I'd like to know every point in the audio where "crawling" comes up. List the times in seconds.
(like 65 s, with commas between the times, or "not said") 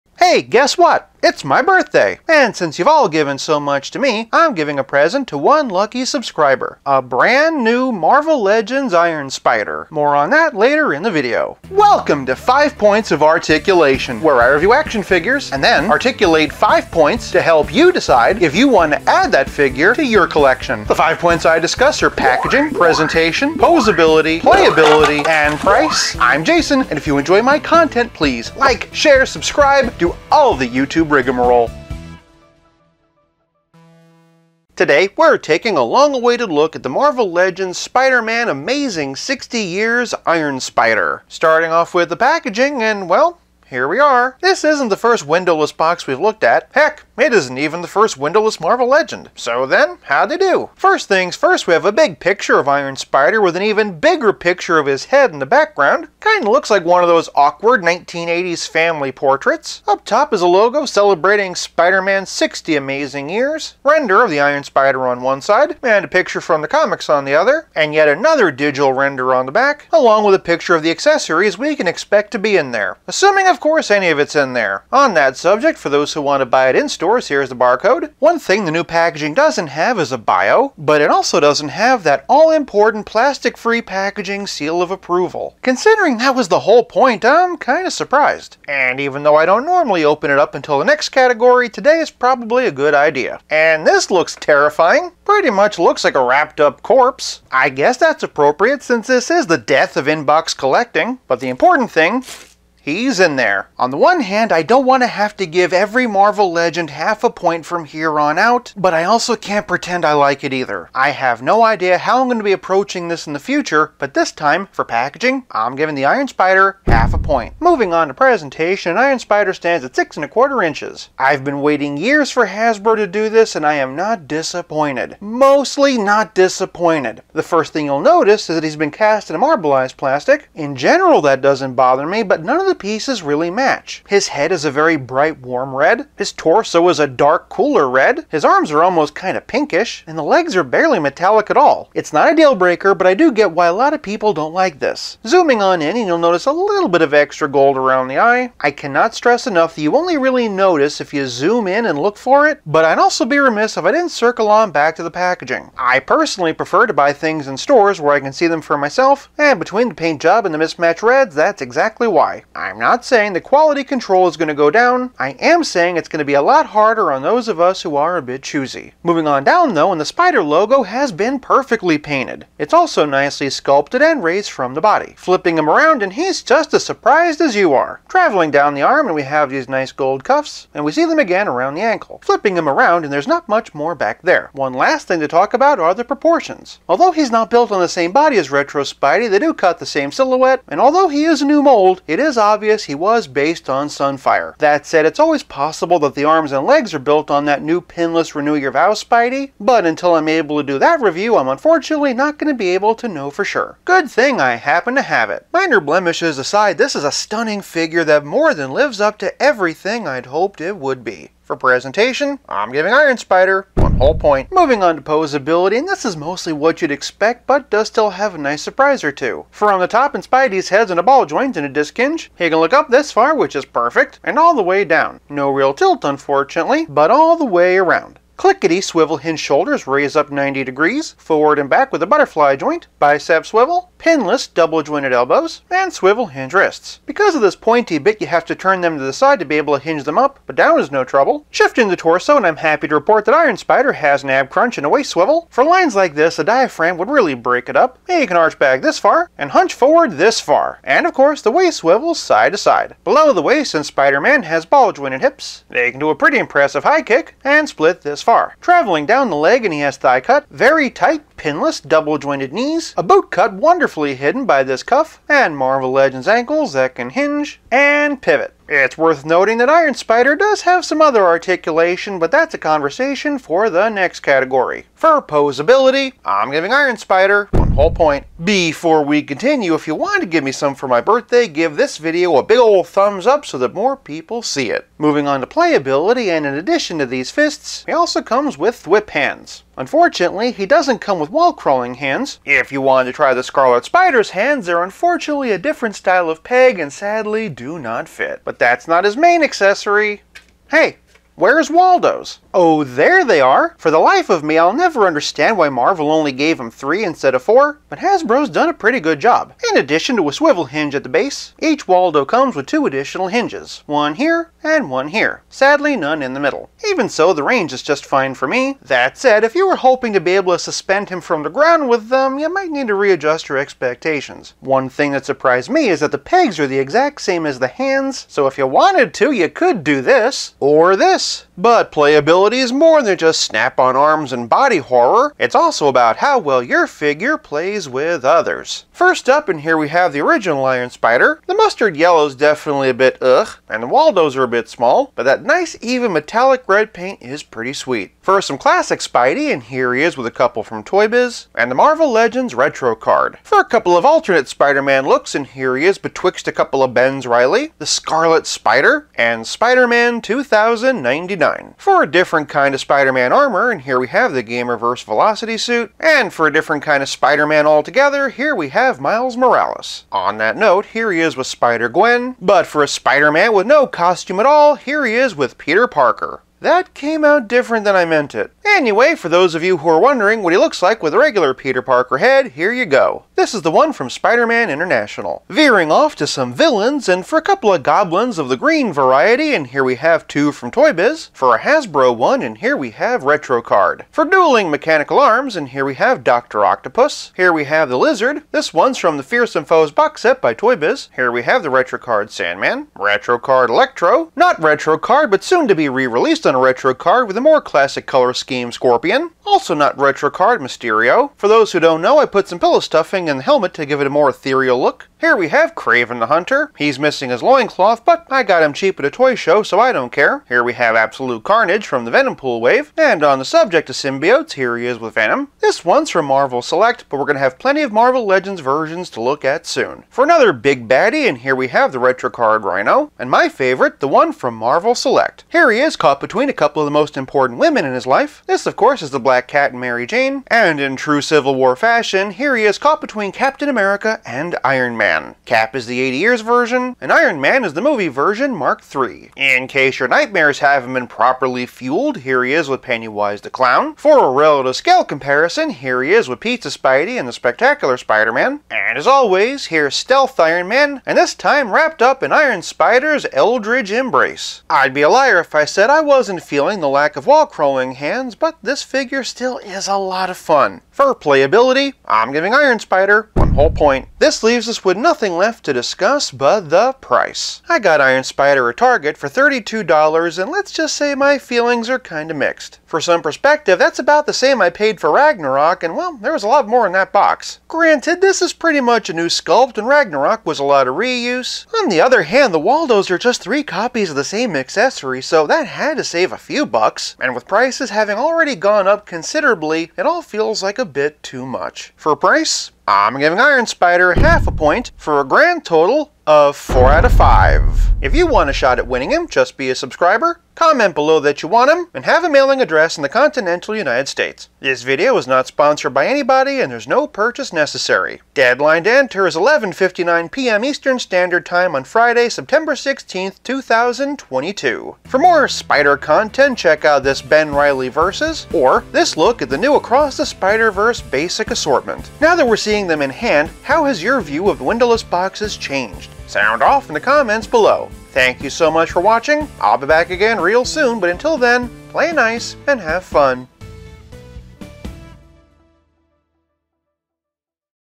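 291 s, 467 s.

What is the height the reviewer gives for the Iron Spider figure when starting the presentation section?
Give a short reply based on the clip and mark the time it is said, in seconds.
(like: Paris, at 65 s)
6 1/4 inches, at 119 s.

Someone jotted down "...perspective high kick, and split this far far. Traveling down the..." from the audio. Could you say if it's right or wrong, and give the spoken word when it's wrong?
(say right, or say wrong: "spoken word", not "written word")
wrong: "impressive", not "perspective".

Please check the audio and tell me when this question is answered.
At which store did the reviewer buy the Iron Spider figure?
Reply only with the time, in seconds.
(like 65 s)
478 s.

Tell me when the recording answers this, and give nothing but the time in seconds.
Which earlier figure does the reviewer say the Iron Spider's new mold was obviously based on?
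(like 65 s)
193 s.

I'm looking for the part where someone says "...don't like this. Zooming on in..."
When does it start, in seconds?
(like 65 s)
144 s.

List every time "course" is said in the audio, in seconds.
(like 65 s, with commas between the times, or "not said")
73 s, 251 s, 438 s.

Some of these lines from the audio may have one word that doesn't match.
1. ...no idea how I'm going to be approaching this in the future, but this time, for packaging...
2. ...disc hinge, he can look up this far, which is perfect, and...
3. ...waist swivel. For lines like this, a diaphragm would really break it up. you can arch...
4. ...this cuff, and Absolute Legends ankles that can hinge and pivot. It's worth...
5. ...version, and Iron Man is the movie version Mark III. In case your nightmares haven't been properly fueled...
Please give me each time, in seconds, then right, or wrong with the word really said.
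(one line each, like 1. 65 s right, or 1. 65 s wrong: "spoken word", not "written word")
1. 111 s right
2. 221 s right
3. 244 s right
4. 264 s wrong: "Marvel", not "Absolute"
5. 446 s right.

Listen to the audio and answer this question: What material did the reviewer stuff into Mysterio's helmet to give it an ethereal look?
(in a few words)
Pillow stuffing.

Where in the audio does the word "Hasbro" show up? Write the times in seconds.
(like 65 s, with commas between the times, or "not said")
122 s, 307 s, 391 s.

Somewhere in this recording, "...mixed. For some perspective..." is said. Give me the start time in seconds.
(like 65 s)
482 s.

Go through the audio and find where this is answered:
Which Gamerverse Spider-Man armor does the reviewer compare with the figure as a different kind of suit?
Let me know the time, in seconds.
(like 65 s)
365 s.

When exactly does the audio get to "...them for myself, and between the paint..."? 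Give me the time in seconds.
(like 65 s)
158 s.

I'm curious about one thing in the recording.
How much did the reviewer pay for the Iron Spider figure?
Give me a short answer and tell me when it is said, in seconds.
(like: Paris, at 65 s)
$32, at 479 s.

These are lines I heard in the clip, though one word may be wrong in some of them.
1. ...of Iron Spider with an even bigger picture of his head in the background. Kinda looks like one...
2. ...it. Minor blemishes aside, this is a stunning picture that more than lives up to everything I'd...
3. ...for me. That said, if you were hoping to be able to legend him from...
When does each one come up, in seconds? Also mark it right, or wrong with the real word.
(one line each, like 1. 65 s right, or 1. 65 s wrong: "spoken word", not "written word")
1. 52 s right
2. 205 s wrong: "figure", not "picture"
3. 318 s wrong: "suspend", not "legend".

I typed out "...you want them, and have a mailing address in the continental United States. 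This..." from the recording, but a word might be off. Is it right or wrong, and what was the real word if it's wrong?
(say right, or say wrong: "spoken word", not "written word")
right.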